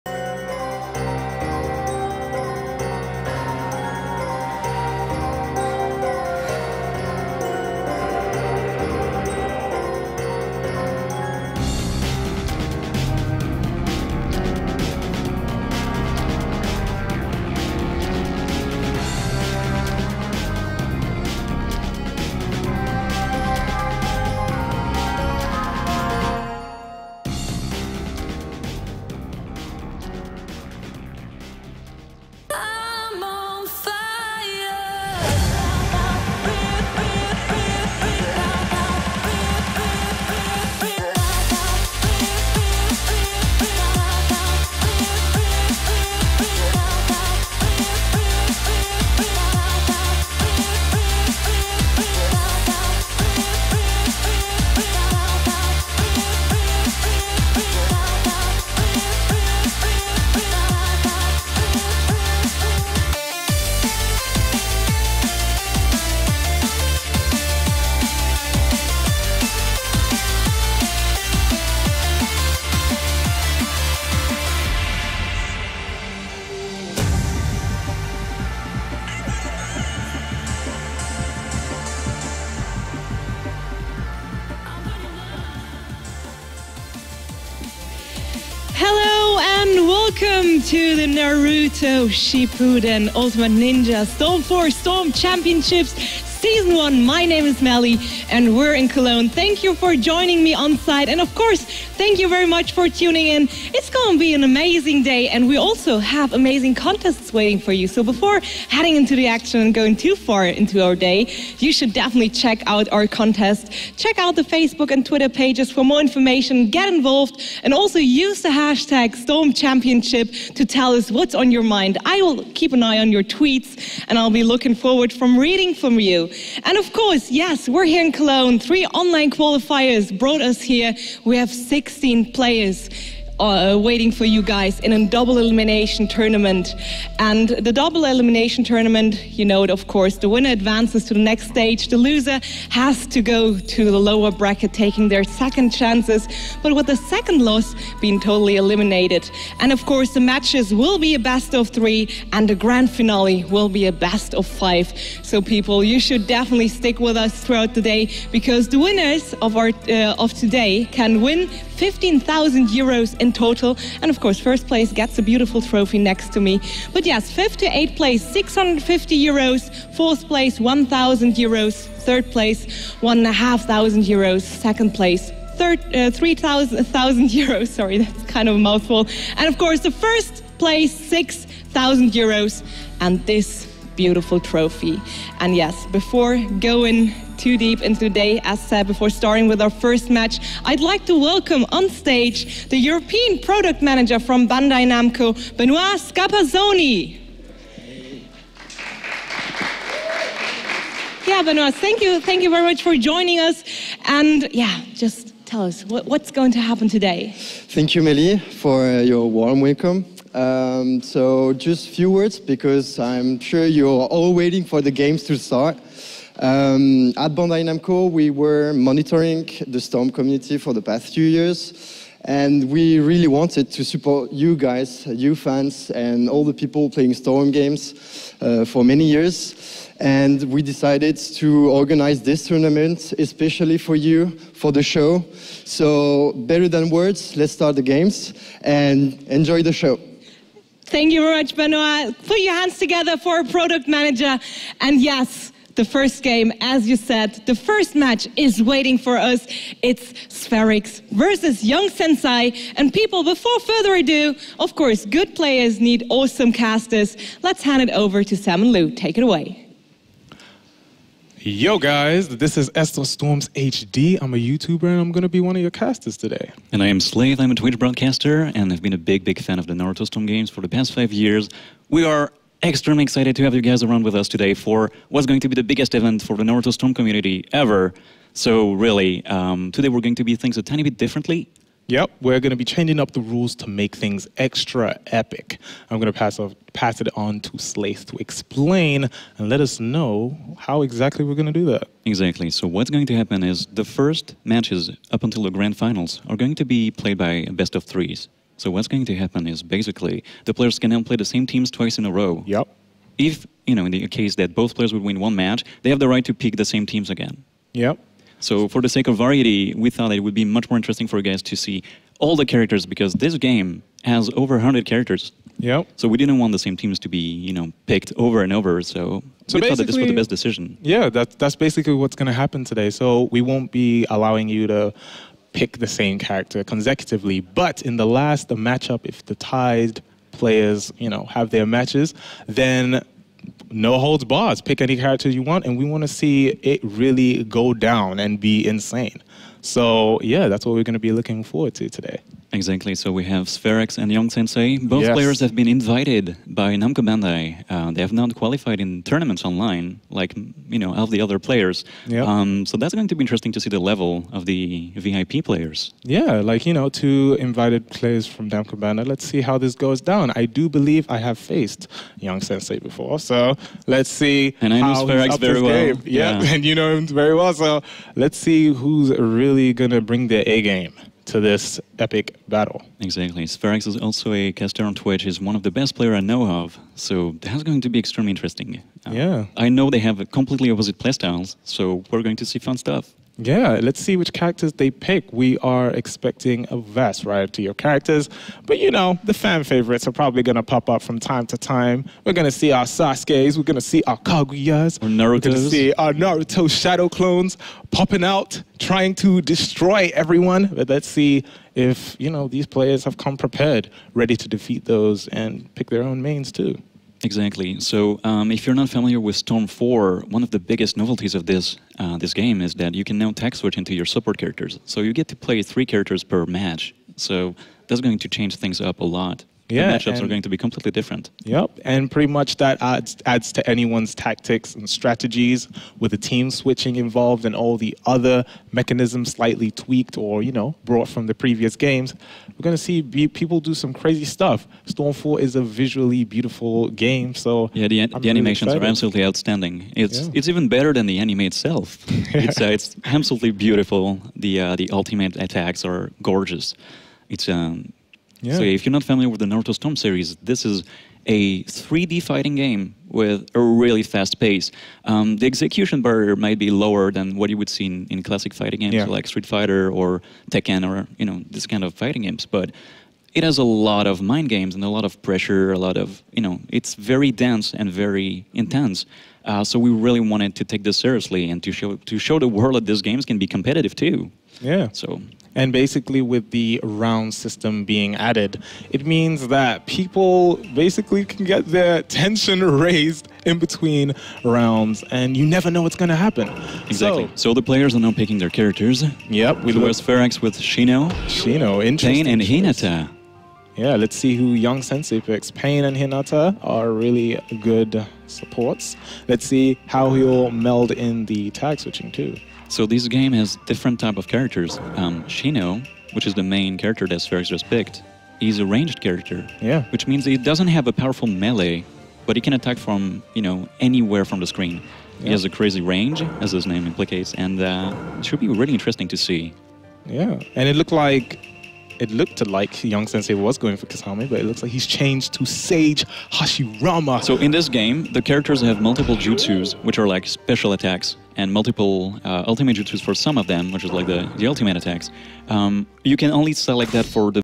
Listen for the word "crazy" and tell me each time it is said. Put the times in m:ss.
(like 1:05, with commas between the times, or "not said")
7:13, 8:35.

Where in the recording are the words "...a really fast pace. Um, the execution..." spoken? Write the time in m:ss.
7:33.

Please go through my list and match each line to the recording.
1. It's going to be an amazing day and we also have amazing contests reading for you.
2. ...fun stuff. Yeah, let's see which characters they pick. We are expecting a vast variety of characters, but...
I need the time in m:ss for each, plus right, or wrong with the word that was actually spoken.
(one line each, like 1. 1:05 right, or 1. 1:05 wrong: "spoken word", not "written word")
1. 1:43 wrong: "waiting", not "reading"
2. 6:22 right.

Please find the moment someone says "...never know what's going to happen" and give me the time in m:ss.
8:05.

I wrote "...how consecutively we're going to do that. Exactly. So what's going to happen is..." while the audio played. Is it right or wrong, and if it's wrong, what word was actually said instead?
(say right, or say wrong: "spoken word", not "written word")
wrong: "exactly", not "consecutively".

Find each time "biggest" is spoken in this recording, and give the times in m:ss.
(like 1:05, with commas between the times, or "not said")
4:35, 6:50.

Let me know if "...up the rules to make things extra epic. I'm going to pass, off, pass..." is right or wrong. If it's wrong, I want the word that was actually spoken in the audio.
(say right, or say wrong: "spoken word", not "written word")
right.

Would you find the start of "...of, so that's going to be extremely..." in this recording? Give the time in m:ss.
6:16.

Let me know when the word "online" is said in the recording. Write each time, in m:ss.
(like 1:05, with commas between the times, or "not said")
2:08, 5:49.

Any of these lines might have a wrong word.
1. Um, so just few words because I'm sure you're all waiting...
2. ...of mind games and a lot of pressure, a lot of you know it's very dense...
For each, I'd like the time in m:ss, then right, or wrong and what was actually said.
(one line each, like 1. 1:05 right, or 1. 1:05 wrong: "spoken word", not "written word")
1. 3:30 right
2. 7:44 right.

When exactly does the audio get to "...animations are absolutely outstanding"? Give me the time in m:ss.
7:18.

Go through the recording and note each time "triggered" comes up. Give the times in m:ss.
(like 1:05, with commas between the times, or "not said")
not said.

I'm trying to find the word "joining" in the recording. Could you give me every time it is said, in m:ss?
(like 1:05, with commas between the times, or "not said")
1:39, 3:22.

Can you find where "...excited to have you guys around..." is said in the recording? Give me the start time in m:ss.
4:33.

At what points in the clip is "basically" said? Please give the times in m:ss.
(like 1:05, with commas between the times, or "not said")
4:59, 5:21, 7:55, 8:00.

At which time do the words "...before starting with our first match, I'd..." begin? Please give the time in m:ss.
3:08.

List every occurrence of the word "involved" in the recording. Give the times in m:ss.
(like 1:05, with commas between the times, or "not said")
1:56, 7:06.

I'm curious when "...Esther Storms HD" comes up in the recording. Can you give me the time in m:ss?
4:22.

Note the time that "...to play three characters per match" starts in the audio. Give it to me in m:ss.
6:55.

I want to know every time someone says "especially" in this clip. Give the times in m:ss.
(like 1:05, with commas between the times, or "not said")
3:53.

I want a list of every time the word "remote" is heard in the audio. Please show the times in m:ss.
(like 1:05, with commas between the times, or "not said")
not said.